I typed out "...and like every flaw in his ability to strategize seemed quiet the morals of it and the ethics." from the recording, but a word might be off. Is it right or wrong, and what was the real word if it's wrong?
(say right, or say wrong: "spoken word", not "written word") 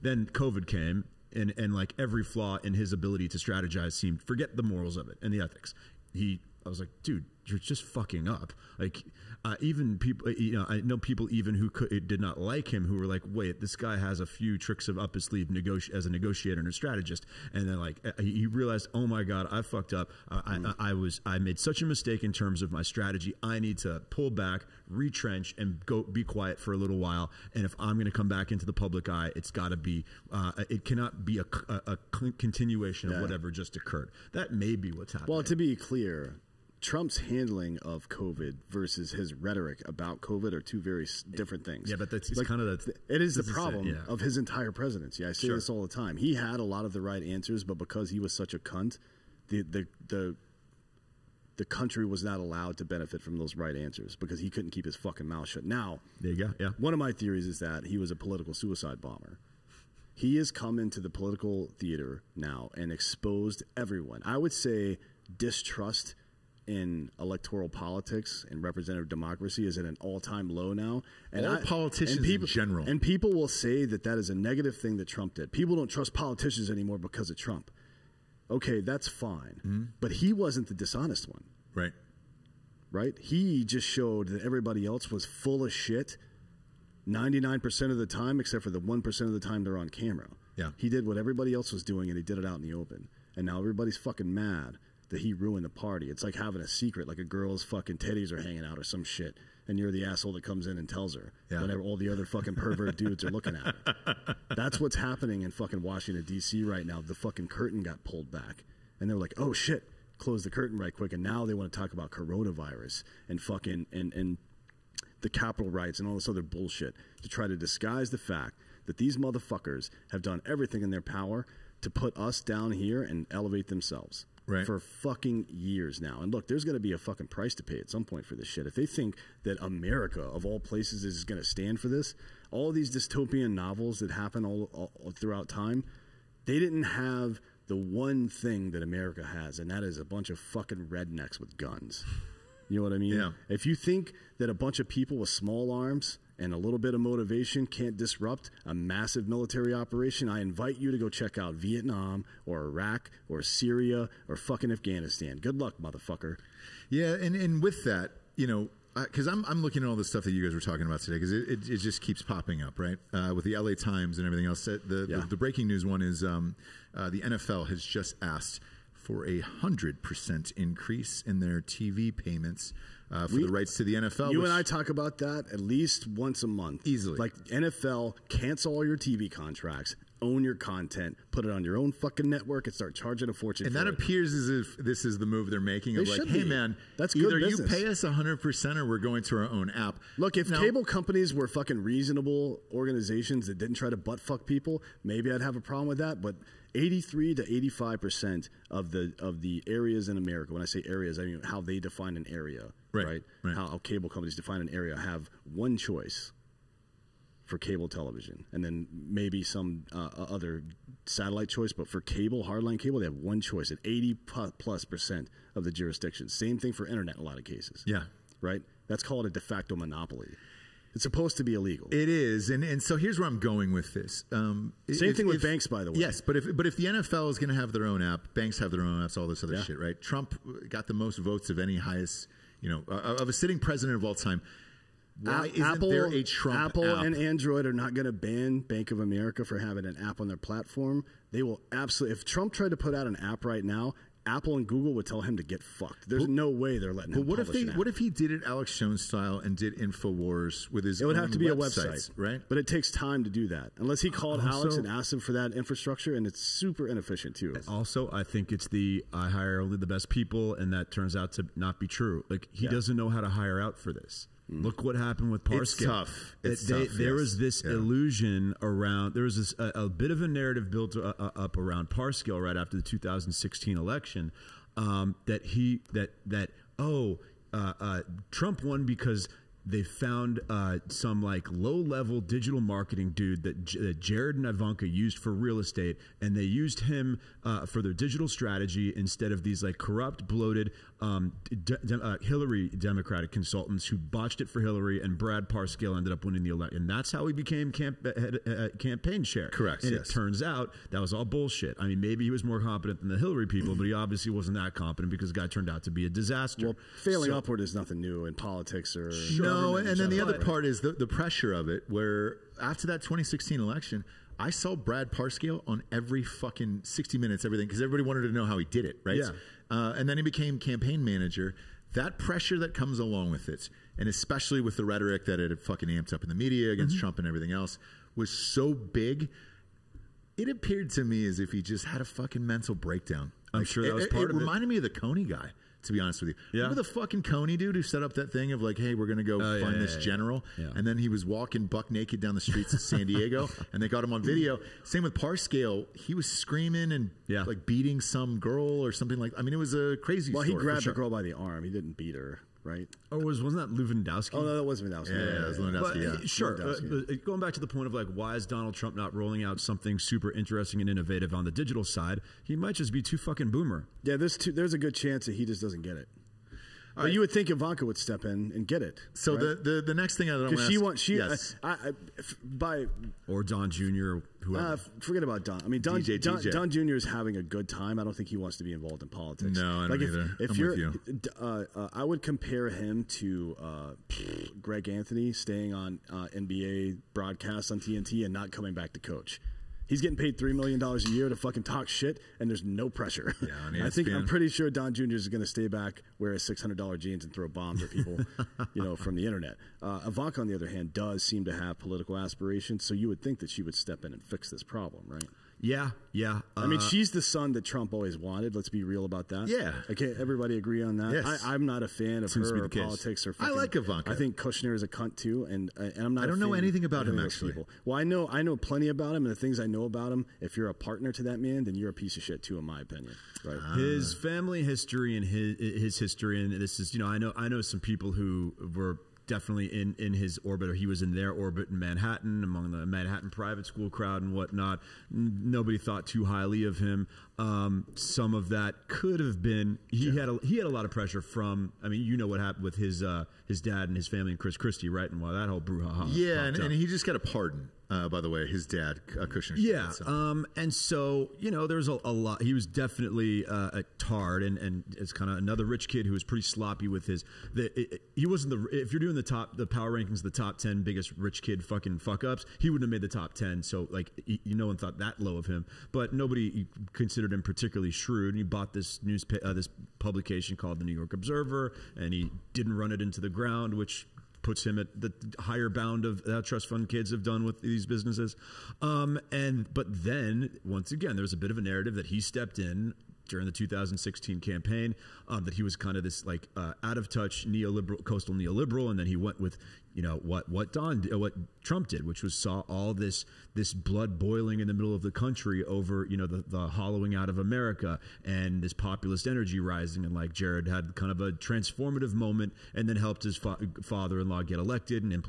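wrong: "forget", not "quiet".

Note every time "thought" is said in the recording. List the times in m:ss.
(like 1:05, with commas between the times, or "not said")
7:15, 7:44.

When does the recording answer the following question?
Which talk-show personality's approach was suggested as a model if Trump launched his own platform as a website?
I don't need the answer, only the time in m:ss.
4:08.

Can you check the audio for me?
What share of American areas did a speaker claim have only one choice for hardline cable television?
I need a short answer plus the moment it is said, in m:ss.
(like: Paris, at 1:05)
83 to 85 percent, at 3:16.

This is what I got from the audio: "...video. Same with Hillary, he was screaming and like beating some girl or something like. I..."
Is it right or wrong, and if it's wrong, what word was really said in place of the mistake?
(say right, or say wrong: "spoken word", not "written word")
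wrong: "Parscale", not "Hillary".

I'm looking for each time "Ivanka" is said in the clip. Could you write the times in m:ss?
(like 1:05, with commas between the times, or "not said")
4:44, 6:07, 6:40, 6:53.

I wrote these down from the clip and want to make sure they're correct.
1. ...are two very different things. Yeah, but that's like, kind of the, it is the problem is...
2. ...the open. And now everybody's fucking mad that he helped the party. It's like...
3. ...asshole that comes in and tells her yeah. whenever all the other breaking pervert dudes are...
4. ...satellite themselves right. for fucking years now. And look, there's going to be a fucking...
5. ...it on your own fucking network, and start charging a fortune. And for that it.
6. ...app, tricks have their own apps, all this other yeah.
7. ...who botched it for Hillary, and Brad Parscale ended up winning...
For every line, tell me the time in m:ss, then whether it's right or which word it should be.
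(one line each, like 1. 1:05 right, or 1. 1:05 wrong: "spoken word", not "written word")
1. 0:40 right
2. 1:32 wrong: "ruined", not "helped"
3. 1:40 wrong: "fucking", not "breaking"
4. 2:03 wrong: "elevate", not "satellite"
5. 3:01 right
6. 3:48 wrong: "banks", not "tricks"
7. 4:53 right.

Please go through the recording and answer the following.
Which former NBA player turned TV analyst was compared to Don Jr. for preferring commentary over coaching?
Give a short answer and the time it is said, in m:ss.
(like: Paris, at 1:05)
Greg Anthony, at 6:24.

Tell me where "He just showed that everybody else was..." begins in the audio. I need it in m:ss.
1:23.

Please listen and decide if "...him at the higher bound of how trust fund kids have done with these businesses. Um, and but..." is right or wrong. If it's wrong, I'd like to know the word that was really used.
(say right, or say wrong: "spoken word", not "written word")
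right.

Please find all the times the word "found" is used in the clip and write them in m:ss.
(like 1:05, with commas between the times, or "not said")
4:39.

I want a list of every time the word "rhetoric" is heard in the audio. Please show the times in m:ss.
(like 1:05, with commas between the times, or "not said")
0:39, 5:24.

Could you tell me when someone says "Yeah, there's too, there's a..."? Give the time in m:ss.
6:04.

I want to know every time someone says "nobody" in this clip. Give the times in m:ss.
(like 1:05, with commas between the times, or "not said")
7:15, 7:46.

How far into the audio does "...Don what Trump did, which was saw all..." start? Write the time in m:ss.
8:10.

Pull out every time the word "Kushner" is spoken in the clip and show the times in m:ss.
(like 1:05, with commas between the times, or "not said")
6:54, 7:29.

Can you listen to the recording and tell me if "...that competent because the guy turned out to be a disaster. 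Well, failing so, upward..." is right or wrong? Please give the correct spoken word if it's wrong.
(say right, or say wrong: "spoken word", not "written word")
right.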